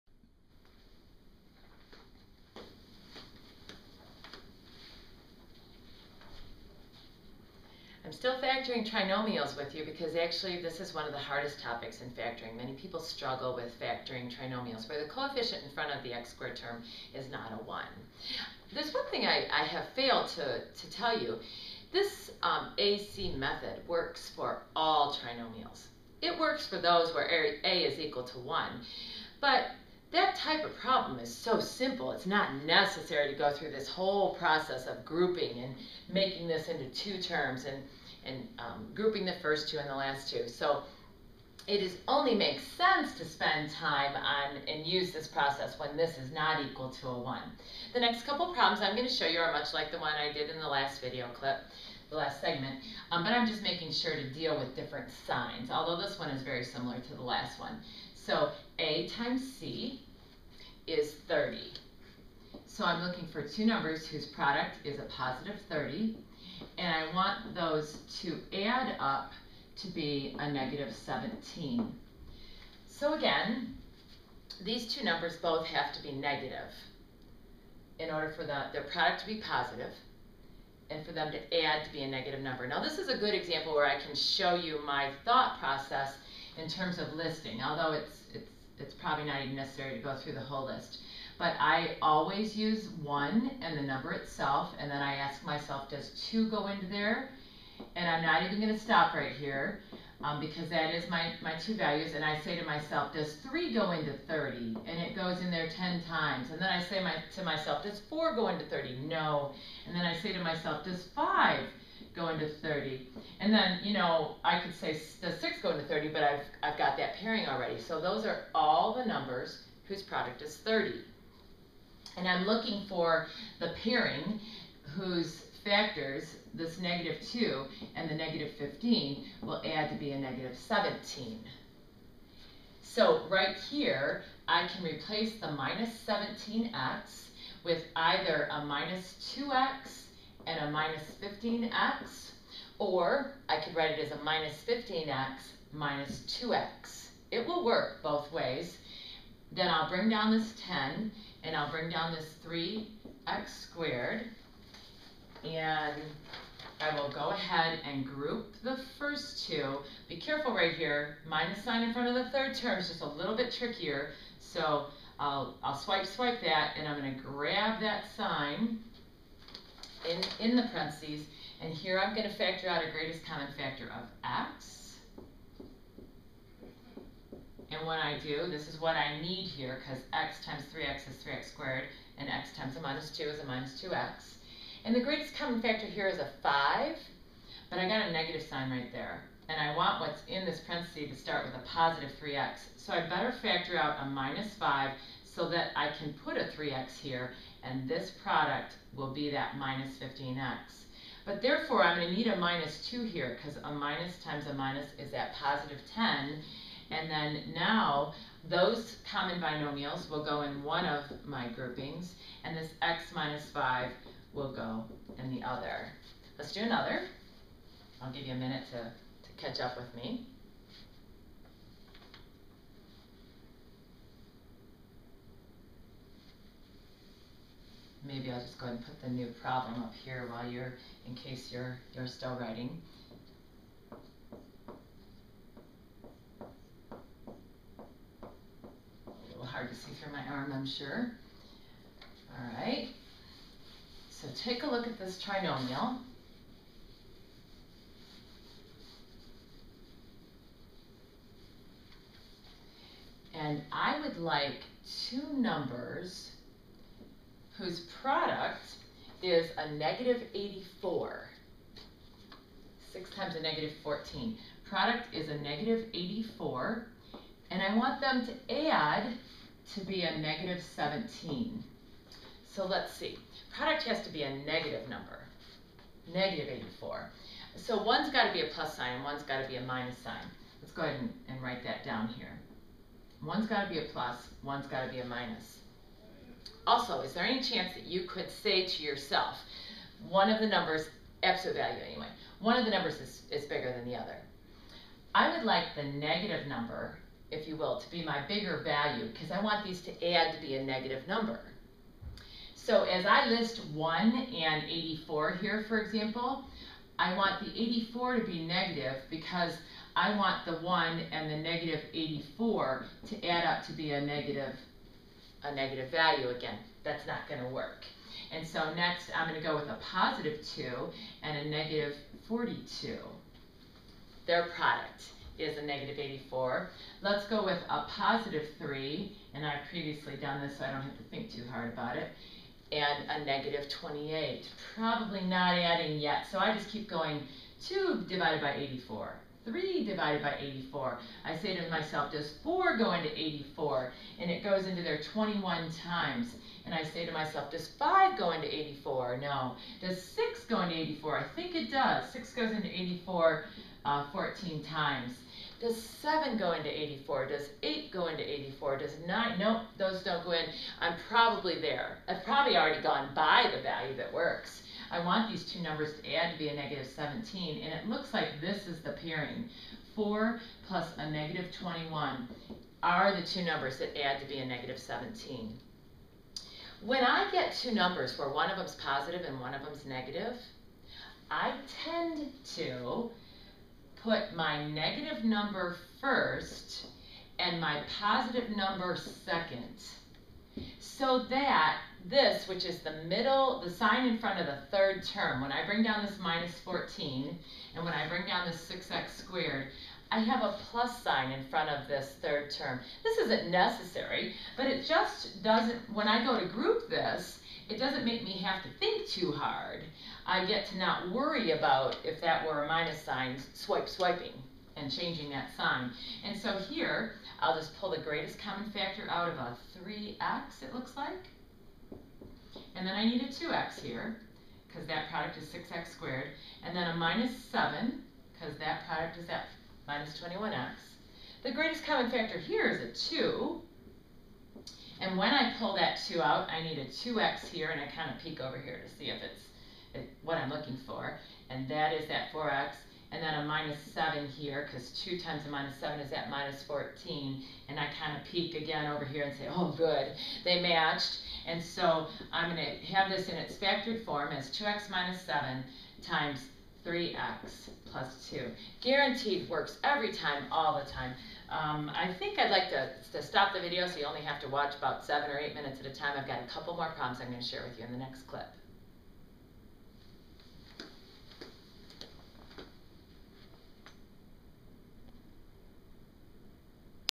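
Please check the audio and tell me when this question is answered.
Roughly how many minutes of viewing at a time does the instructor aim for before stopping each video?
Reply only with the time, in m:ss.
7:45.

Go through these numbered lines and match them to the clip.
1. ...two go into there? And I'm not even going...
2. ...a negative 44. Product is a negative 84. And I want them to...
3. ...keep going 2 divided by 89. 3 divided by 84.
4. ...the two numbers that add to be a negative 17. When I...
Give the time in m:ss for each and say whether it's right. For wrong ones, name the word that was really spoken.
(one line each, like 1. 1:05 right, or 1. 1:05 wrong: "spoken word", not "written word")
1. 1:36 right
2. 4:23 wrong: "14", not "44"
3. 5:36 wrong: "84", not "89"
4. 6:13 right.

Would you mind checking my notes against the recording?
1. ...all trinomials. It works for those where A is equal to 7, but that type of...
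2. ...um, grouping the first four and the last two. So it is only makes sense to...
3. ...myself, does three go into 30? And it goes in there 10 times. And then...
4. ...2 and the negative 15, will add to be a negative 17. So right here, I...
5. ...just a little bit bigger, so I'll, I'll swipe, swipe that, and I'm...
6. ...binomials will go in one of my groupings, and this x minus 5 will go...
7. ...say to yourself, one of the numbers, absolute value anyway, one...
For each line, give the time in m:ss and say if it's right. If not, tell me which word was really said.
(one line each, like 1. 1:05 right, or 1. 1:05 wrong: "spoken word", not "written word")
1. 0:24 wrong: "1", not "7"
2. 0:38 wrong: "two", not "four"
3. 1:42 right
4. 2:07 right
5. 2:42 wrong: "trickier", not "bigger"
6. 3:29 right
7. 4:48 right.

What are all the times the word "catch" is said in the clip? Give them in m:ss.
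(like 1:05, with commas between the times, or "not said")
3:39.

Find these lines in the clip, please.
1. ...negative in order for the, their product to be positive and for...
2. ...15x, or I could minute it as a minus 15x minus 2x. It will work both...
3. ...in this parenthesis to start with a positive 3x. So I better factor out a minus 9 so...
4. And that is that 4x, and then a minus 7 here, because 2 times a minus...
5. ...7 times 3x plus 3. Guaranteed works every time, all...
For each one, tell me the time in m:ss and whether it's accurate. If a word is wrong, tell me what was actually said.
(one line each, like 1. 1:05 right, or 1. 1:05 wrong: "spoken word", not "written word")
1. 1:16 right
2. 2:21 wrong: "write", not "minute"
3. 3:10 wrong: "5", not "9"
4. 7:21 right
5. 7:35 wrong: "2", not "3".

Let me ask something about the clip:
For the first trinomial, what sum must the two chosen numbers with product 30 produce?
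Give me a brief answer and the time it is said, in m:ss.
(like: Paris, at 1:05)
-17, at 1:08.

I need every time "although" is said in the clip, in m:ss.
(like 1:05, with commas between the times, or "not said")
0:55, 1:27.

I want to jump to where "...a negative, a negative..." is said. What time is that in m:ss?
5:13.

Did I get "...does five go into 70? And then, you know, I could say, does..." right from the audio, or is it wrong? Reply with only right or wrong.
wrong.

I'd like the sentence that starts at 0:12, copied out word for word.
Many people struggle with factoring trinomials where the coefficient in front of the x squared term is not a 1.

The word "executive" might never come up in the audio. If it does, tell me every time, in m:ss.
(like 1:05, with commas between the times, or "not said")
not said.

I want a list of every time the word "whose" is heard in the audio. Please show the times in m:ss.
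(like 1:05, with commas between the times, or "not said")
1:04, 1:59, 2:04, 4:17.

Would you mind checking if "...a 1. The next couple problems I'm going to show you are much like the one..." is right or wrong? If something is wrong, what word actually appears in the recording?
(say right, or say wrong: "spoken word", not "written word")
right.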